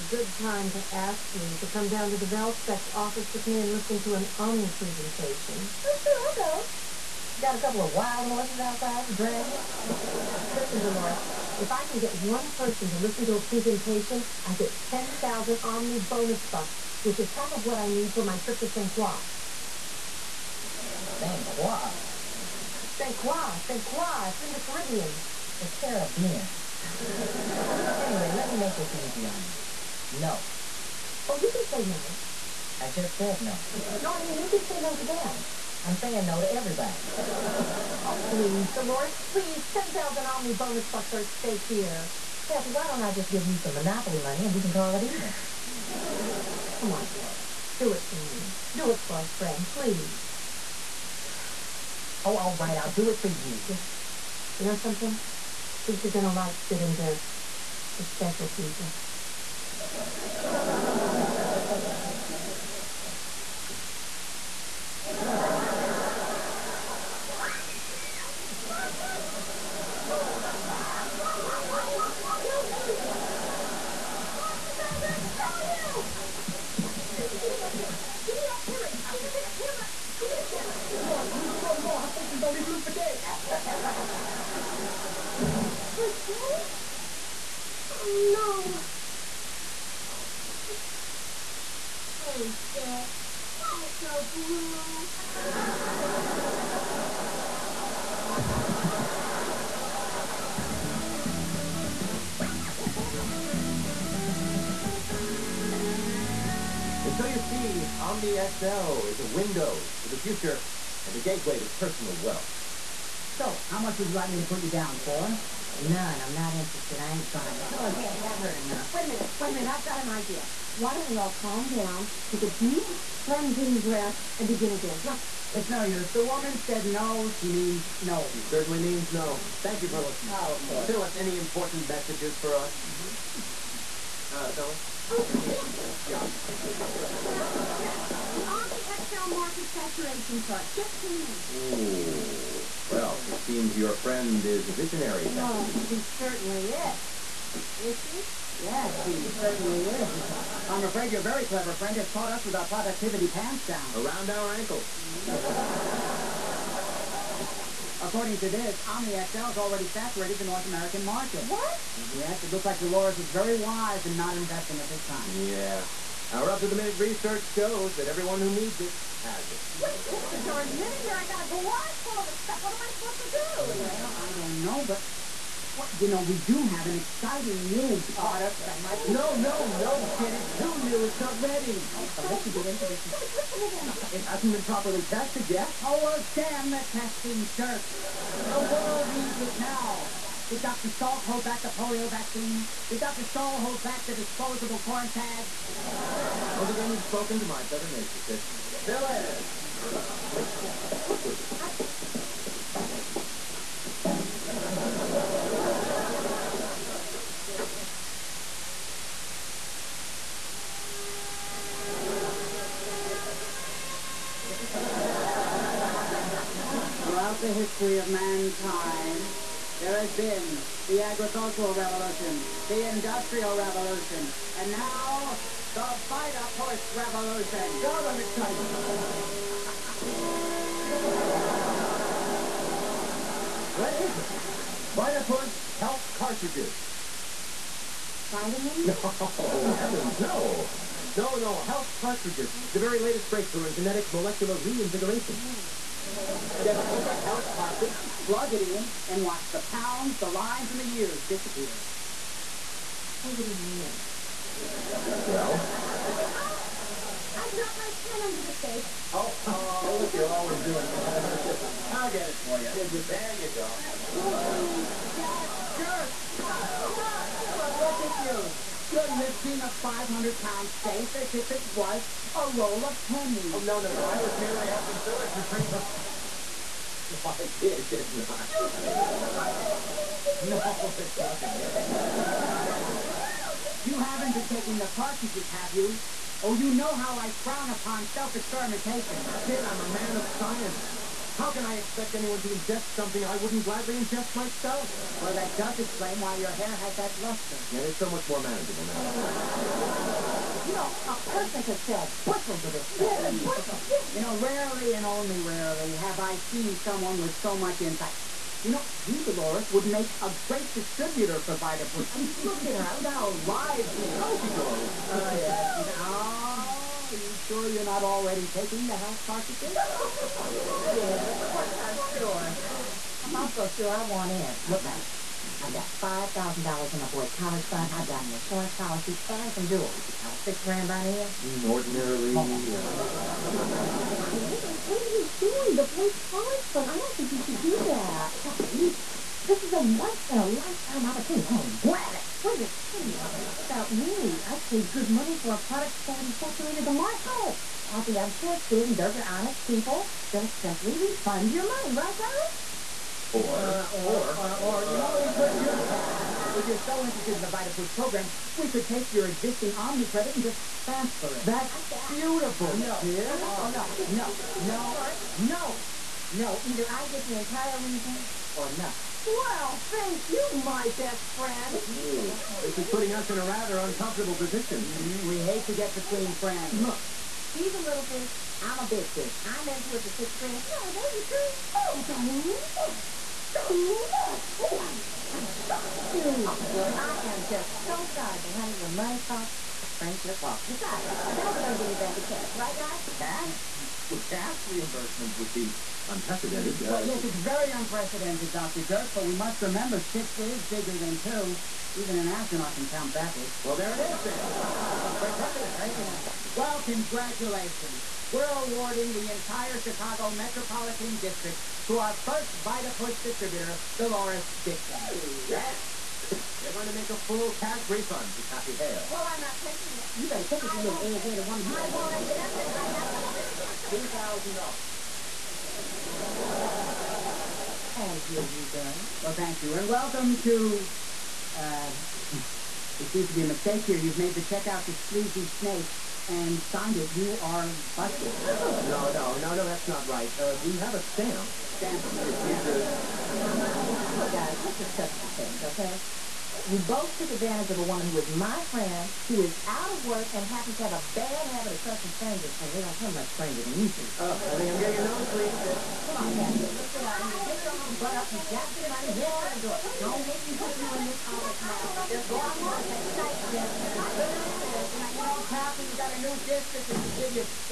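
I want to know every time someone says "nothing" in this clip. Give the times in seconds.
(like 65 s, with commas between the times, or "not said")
281 s, 368 s.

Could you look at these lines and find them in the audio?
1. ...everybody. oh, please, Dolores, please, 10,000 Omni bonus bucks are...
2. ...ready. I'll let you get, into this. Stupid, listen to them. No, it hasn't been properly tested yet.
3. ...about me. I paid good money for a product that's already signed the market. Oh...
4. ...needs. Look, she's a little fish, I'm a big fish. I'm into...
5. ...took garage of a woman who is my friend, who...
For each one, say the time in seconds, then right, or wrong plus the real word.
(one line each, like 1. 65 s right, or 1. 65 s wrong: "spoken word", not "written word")
1. 36 s right
2. 181 s right
3. 342 s wrong: "saturated", not "signed"
4. 376 s wrong: "friends", not "needs"
5. 447 s wrong: "advantage", not "garage".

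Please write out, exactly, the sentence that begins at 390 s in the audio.
Besides, the guys are going to give you back the cash, right, guys?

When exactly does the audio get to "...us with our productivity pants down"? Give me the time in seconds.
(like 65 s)
152 s.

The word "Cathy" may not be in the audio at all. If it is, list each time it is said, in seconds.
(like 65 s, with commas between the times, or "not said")
42 s, 338 s, 347 s, 418 s, 456 s, 465 s.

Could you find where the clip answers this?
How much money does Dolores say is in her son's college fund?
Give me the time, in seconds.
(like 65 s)
326 s.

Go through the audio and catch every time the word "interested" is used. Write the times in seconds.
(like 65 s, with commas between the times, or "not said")
116 s, 357 s.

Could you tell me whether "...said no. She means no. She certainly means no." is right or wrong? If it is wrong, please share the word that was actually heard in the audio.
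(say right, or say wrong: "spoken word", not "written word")
right.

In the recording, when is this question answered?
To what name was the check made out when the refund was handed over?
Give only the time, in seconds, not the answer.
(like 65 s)
434 s.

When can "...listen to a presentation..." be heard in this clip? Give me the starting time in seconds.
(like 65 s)
12 s.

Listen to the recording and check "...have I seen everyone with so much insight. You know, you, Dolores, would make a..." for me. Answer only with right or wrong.
wrong.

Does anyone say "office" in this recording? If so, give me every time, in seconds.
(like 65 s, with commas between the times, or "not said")
2 s, 461 s.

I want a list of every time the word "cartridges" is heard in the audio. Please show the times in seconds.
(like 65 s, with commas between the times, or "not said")
236 s, 241 s, 247 s, 284 s, 319 s.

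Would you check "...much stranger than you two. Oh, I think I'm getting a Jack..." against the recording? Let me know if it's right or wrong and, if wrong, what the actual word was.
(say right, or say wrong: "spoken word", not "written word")
wrong: "Come", not "Jack".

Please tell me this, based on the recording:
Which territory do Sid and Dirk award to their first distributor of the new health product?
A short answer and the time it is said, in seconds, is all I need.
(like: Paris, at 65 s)
Chicago Metropolitan District, at 409 s.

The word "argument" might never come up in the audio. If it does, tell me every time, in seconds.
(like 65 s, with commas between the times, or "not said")
not said.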